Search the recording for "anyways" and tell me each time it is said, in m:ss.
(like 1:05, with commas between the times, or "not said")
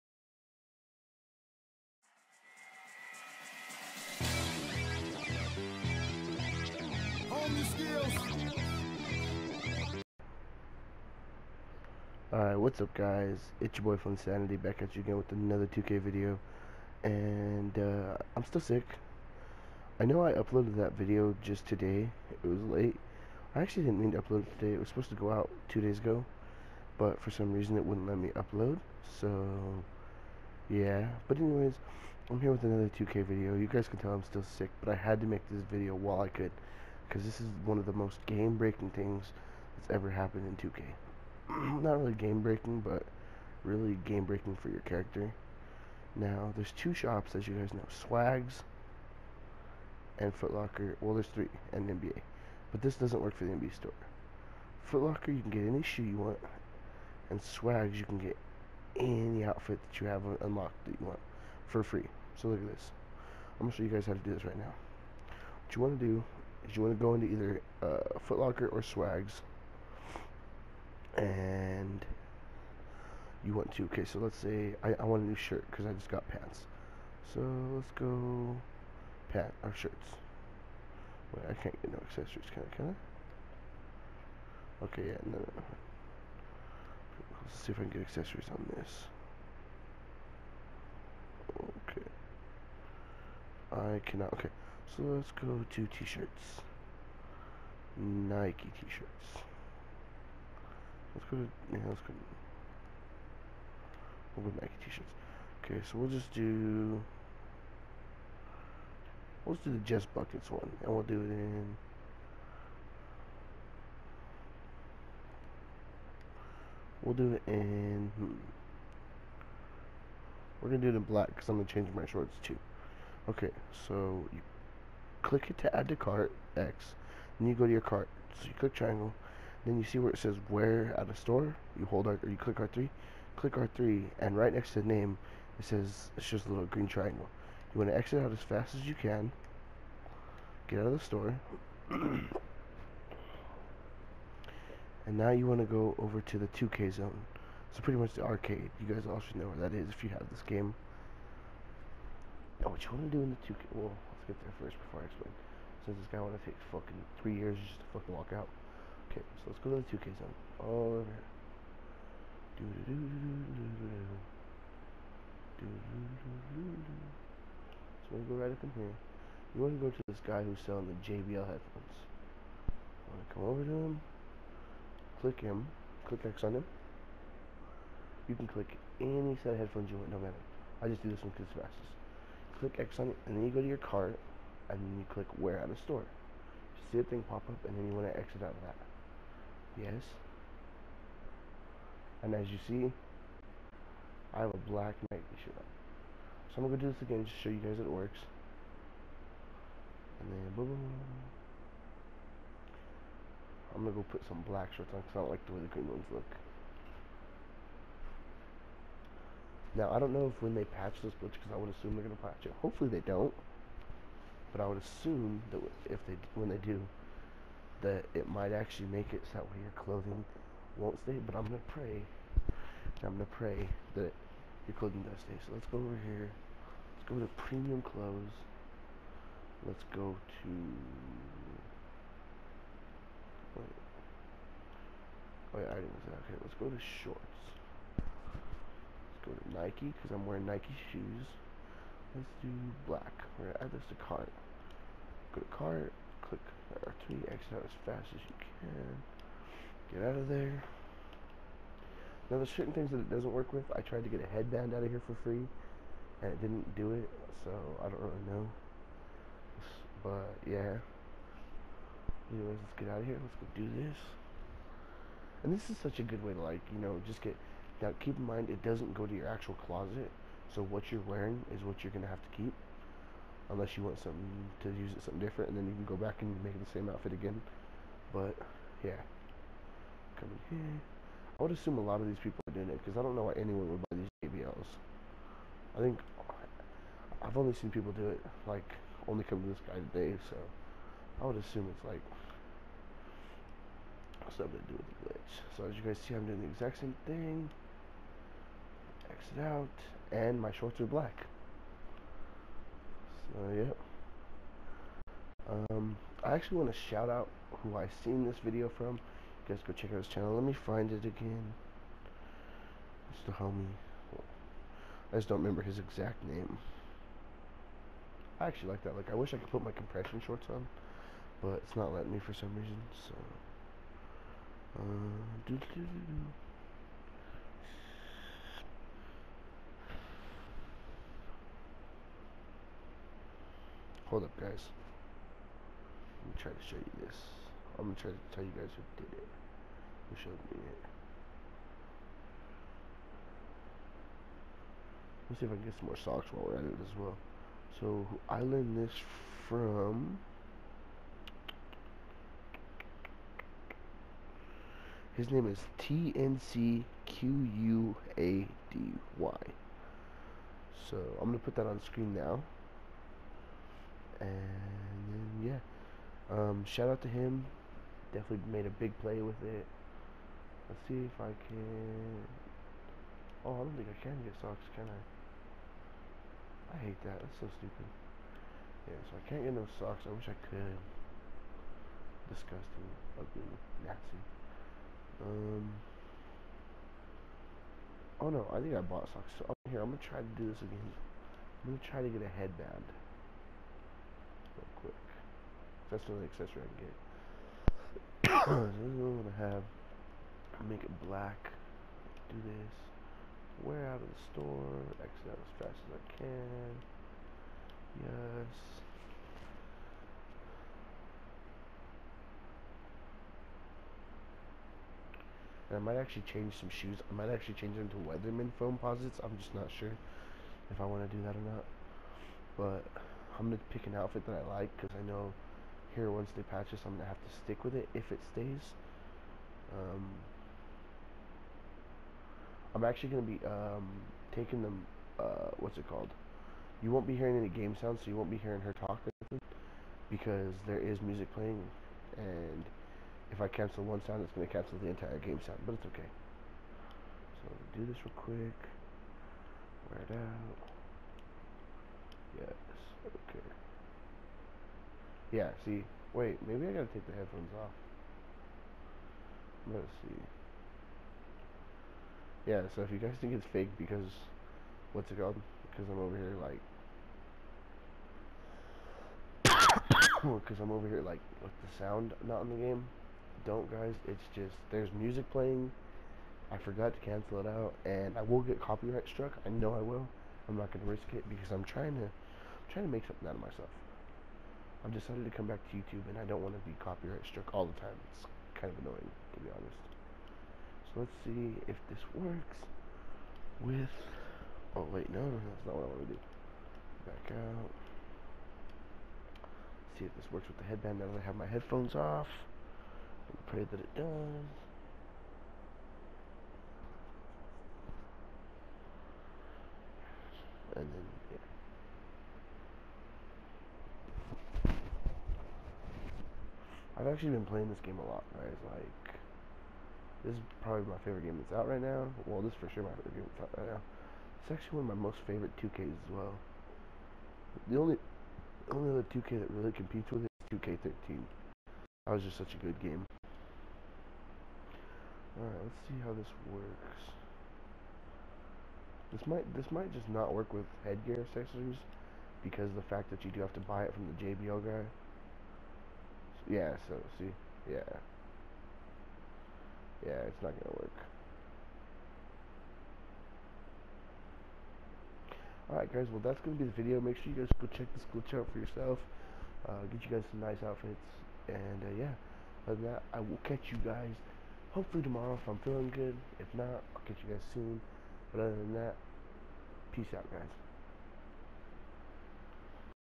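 0:31, 4:22.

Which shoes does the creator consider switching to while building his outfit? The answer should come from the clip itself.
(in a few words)
Weatherman Foamposites.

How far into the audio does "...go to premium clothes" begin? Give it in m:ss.
3:47.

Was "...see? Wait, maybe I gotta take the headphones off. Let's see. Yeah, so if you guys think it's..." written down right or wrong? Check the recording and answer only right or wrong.
right.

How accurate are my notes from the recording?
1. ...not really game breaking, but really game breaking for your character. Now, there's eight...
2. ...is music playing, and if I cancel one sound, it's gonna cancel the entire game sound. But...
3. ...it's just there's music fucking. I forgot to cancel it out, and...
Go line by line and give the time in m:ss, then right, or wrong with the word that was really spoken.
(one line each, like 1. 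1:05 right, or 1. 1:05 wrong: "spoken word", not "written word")
1. 0:41 wrong: "two", not "eight"
2. 7:20 right
3. 7:54 wrong: "playing", not "fucking".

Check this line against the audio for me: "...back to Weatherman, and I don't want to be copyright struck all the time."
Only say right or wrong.
wrong.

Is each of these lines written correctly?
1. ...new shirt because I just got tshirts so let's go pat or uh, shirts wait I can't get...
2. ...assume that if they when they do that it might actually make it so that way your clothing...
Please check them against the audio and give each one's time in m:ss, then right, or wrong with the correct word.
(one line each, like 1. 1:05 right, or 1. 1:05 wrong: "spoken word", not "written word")
1. 1:15 wrong: "pants", not "tshirts"
2. 3:34 right.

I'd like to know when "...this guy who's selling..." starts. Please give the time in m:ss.
2:50.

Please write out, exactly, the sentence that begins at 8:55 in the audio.
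Alright, let's see how this works.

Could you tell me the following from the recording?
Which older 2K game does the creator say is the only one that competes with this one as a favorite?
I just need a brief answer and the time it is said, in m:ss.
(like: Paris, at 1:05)
2K13, at 8:50.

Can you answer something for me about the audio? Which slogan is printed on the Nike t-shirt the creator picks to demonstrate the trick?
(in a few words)
Just Buckets.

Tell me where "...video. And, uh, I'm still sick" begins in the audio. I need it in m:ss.
0:15.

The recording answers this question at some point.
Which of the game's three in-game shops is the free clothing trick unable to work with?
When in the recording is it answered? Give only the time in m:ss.
0:53.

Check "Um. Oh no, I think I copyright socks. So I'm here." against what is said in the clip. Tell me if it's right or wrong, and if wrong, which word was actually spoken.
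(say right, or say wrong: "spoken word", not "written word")
wrong: "bought", not "copyright".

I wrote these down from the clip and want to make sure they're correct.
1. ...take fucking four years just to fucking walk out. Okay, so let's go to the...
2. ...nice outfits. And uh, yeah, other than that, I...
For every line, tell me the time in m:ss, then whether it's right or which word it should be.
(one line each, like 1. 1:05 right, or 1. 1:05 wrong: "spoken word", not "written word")
1. 2:36 wrong: "three", not "four"
2. 9:20 right.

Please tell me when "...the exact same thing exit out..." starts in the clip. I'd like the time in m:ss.
4:56.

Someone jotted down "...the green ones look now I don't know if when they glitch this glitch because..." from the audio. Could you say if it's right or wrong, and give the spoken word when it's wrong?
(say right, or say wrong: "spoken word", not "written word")
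wrong: "patch", not "glitch".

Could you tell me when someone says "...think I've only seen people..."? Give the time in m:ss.
4:45.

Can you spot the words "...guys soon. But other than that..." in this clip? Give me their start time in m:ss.
9:27.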